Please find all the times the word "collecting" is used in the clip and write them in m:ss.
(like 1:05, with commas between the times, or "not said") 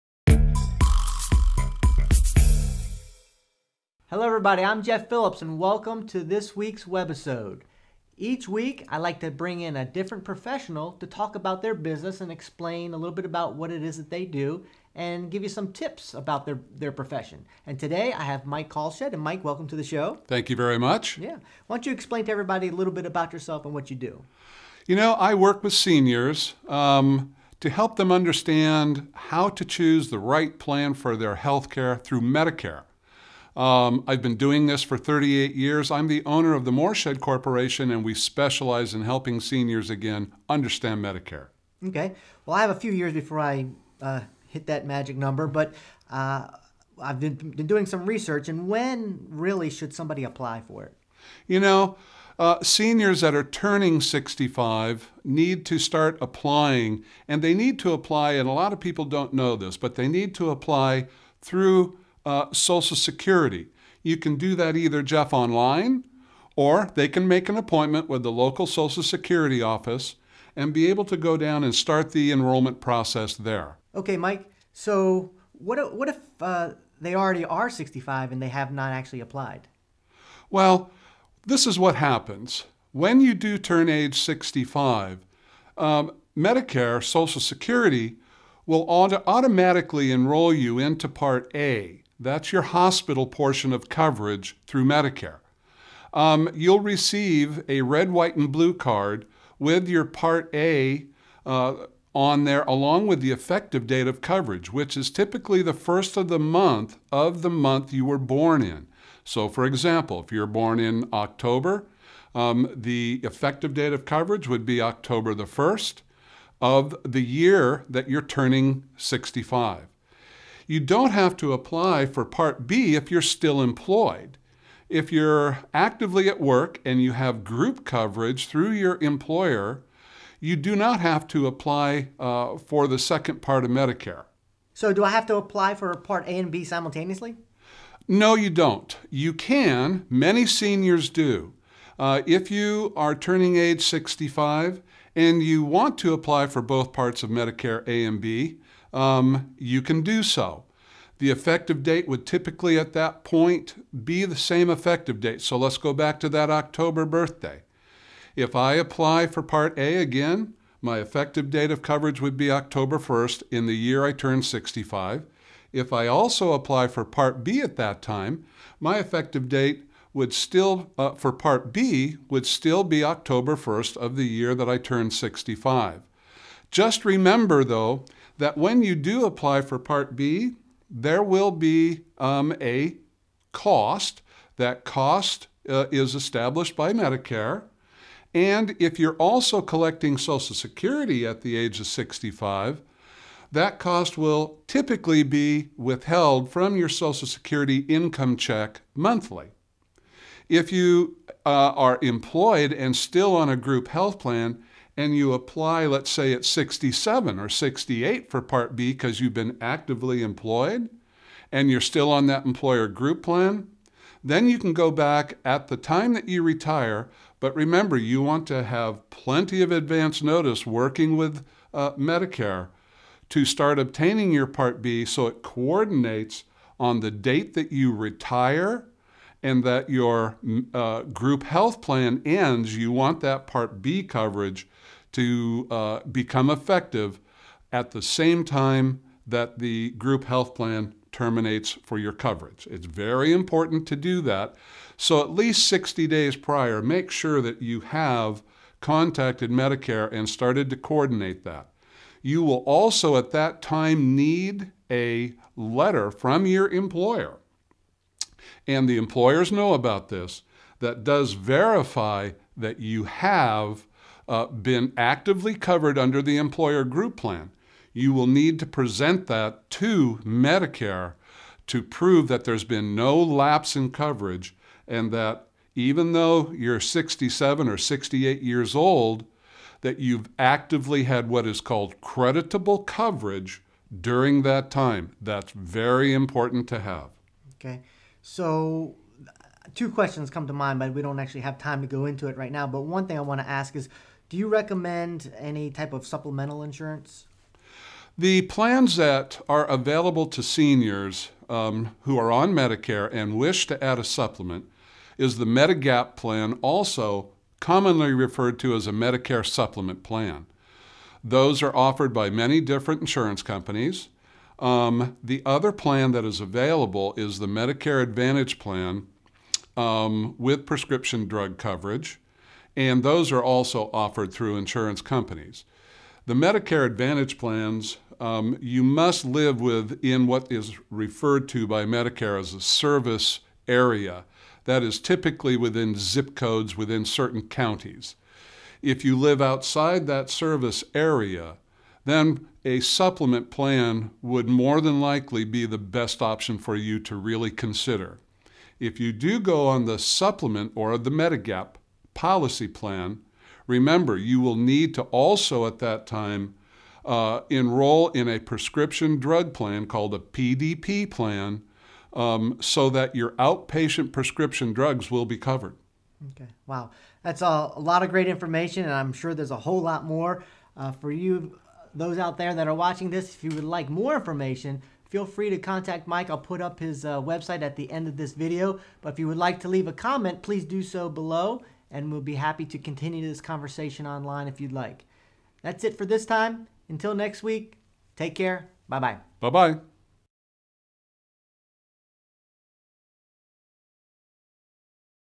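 3:09.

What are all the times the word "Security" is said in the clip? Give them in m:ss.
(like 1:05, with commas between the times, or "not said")
1:02, 1:09, 1:27, 3:10, 3:17.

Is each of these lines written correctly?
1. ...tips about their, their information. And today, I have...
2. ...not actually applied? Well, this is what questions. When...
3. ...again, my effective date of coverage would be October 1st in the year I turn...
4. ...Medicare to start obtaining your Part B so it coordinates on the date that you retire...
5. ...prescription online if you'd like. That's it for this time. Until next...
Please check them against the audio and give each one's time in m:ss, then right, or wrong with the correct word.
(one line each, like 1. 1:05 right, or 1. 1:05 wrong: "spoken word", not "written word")
1. 0:15 wrong: "profession", not "information"
2. 1:18 wrong: "happens", not "questions"
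3. 2:39 right
4. 3:41 right
5. 6:23 wrong: "conversation", not "prescription".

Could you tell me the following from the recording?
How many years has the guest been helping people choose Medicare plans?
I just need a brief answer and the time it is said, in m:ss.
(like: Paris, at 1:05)
38, at 0:34.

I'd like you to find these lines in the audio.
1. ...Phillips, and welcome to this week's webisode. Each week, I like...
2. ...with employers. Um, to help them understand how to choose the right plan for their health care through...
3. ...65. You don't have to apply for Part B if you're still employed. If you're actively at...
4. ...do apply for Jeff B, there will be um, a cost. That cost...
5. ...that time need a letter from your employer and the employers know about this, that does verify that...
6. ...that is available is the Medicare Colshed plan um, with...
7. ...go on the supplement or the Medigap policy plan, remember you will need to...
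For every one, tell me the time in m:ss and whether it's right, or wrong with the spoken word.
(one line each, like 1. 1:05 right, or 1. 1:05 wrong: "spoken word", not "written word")
1. 0:05 right
2. 0:25 wrong: "seniors", not "employers"
3. 1:58 right
4. 2:58 wrong: "Part", not "Jeff"
5. 4:13 right
6. 5:16 wrong: "Advantage", not "Colshed"
7. 5:49 right.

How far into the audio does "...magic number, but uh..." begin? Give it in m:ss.
0:44.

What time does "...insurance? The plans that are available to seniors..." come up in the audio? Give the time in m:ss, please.
4:56.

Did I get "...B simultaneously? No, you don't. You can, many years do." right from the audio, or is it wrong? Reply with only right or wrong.
wrong.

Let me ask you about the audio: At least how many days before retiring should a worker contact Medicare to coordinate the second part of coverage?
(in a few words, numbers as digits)
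60.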